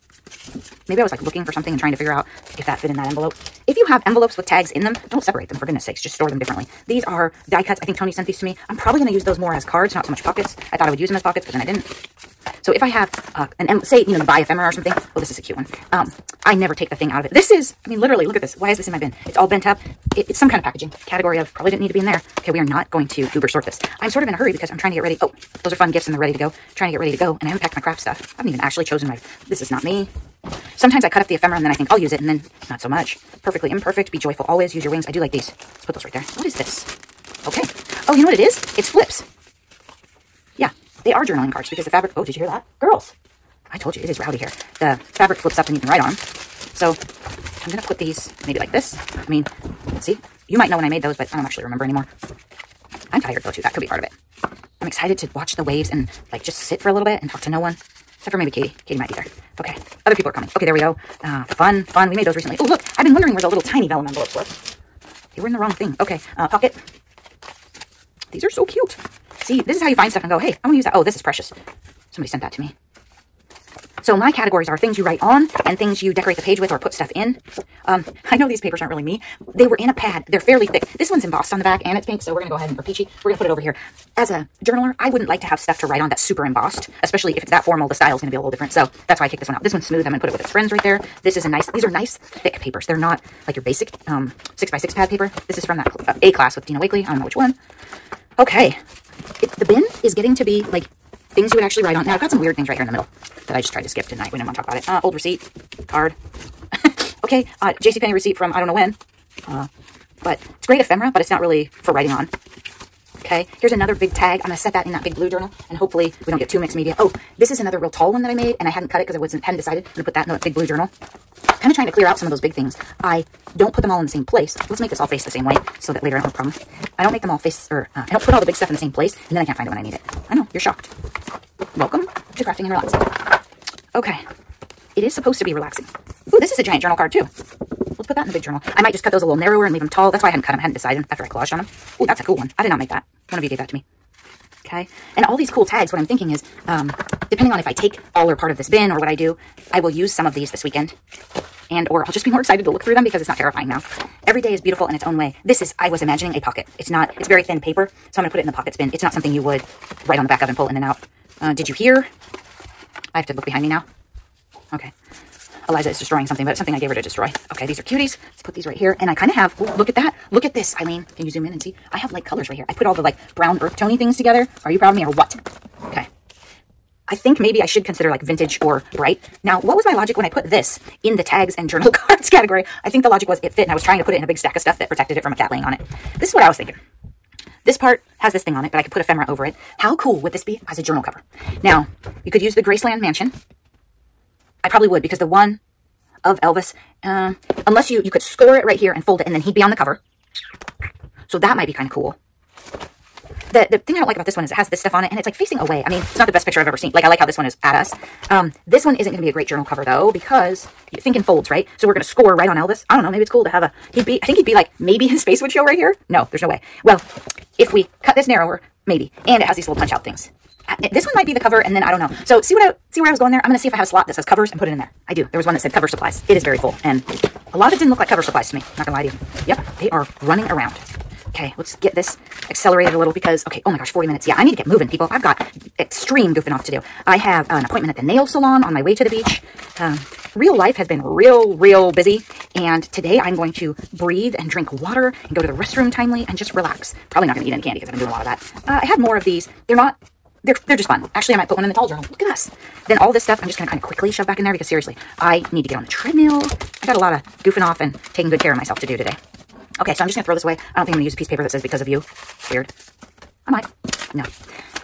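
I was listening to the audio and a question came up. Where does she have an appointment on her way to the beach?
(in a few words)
the nail salon.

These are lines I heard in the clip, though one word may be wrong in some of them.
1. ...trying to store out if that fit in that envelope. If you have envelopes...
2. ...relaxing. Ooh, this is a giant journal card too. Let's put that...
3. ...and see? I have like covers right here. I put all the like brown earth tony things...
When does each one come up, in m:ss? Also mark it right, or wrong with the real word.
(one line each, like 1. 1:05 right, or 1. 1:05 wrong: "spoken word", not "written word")
1. 0:01 wrong: "figure", not "store"
2. 2:15 right
3. 2:51 wrong: "colors", not "covers".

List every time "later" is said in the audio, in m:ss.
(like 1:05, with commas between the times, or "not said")
2:06.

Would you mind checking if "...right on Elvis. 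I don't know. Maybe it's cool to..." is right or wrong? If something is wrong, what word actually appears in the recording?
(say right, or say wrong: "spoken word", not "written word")
right.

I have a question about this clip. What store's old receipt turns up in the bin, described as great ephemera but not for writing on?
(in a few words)
JCPenney.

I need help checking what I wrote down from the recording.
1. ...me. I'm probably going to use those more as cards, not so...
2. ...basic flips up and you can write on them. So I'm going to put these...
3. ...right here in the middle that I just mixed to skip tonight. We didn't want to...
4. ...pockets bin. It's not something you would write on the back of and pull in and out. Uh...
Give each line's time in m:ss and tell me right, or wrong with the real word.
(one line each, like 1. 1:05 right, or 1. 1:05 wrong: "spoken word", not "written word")
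1. 0:08 right
2. 0:45 wrong: "fabric", not "basic"
3. 1:42 wrong: "tried", not "mixed"
4. 2:38 right.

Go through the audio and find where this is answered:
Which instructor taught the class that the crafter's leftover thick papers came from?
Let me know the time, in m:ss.
1:36.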